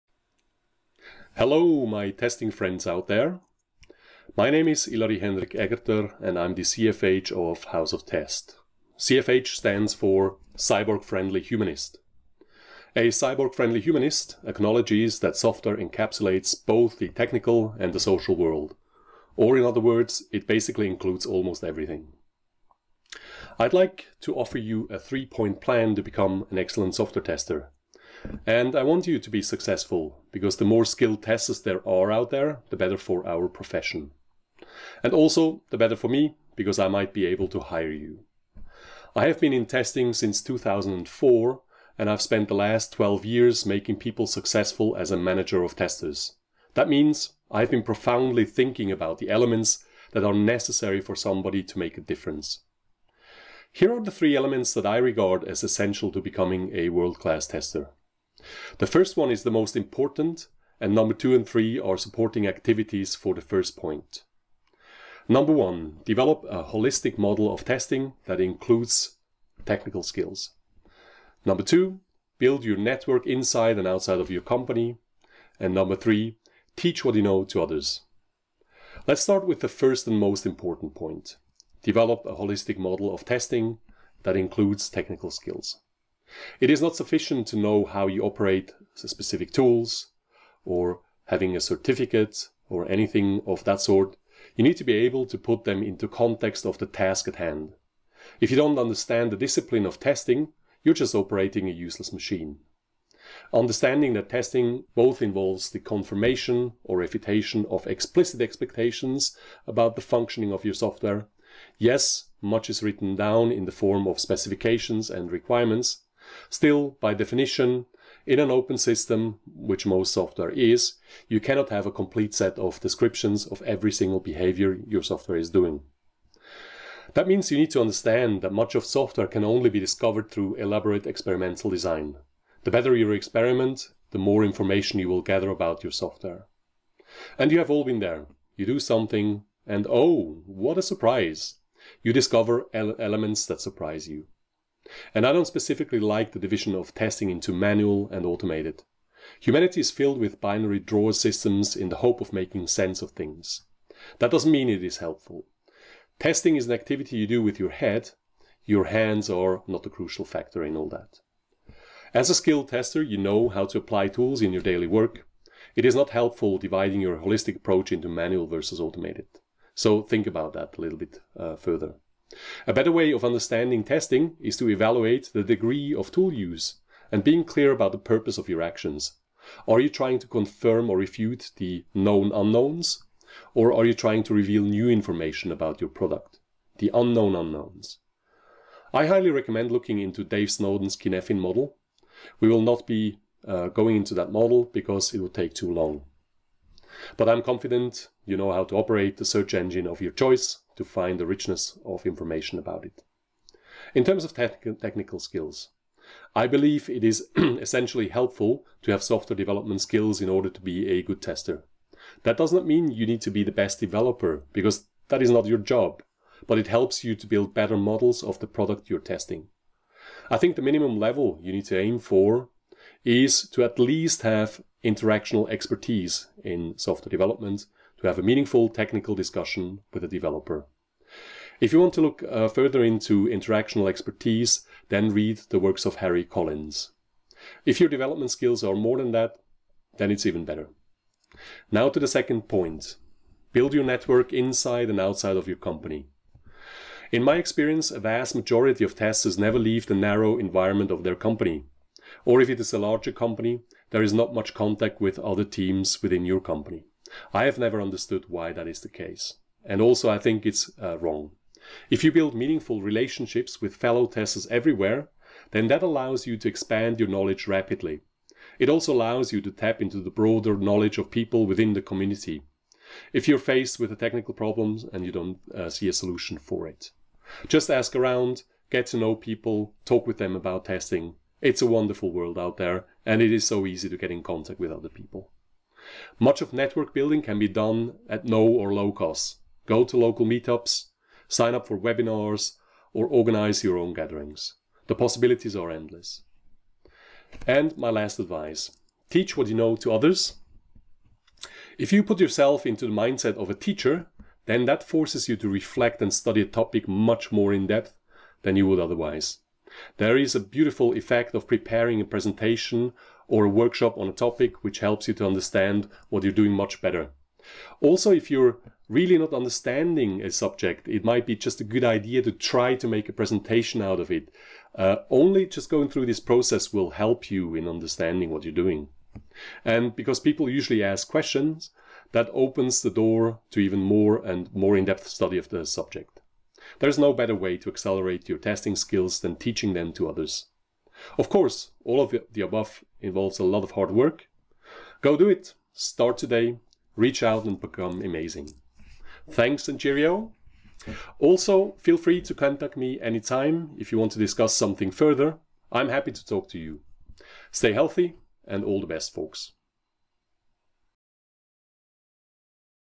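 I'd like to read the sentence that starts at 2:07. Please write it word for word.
That means you need to understand that much of software can only be discovered through elaborate experimental design.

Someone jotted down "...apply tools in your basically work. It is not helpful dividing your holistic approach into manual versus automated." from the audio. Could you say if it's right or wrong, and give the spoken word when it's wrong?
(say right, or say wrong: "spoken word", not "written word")
wrong: "daily", not "basically".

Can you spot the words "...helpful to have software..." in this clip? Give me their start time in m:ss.
3:28.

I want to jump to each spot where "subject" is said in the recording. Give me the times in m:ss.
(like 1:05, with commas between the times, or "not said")
5:20, 5:35.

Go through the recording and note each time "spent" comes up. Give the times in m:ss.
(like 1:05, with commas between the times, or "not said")
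0:42.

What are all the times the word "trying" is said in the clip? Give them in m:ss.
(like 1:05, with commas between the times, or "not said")
2:59, 3:03.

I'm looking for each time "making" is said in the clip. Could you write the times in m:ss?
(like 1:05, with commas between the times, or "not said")
0:43, 2:32.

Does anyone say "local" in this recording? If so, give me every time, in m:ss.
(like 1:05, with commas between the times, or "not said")
4:49.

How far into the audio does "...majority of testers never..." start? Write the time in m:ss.
4:08.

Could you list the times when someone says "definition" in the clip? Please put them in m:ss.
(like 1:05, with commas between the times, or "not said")
1:57.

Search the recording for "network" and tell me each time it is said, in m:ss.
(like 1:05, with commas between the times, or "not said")
1:12, 4:03, 4:46.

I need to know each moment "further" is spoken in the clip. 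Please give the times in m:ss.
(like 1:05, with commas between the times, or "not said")
2:51, 3:52, 5:54.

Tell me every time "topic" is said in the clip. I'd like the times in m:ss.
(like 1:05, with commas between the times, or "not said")
5:06, 5:14.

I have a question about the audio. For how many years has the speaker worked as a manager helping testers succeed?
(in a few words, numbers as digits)
12.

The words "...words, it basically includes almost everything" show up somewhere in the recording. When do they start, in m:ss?
0:19.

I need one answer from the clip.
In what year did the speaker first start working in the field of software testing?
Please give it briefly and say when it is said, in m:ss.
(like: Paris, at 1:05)
2004, at 0:40.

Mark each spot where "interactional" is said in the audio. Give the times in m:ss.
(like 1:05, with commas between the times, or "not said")
3:44, 3:53.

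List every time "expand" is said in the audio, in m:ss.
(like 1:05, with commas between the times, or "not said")
4:26.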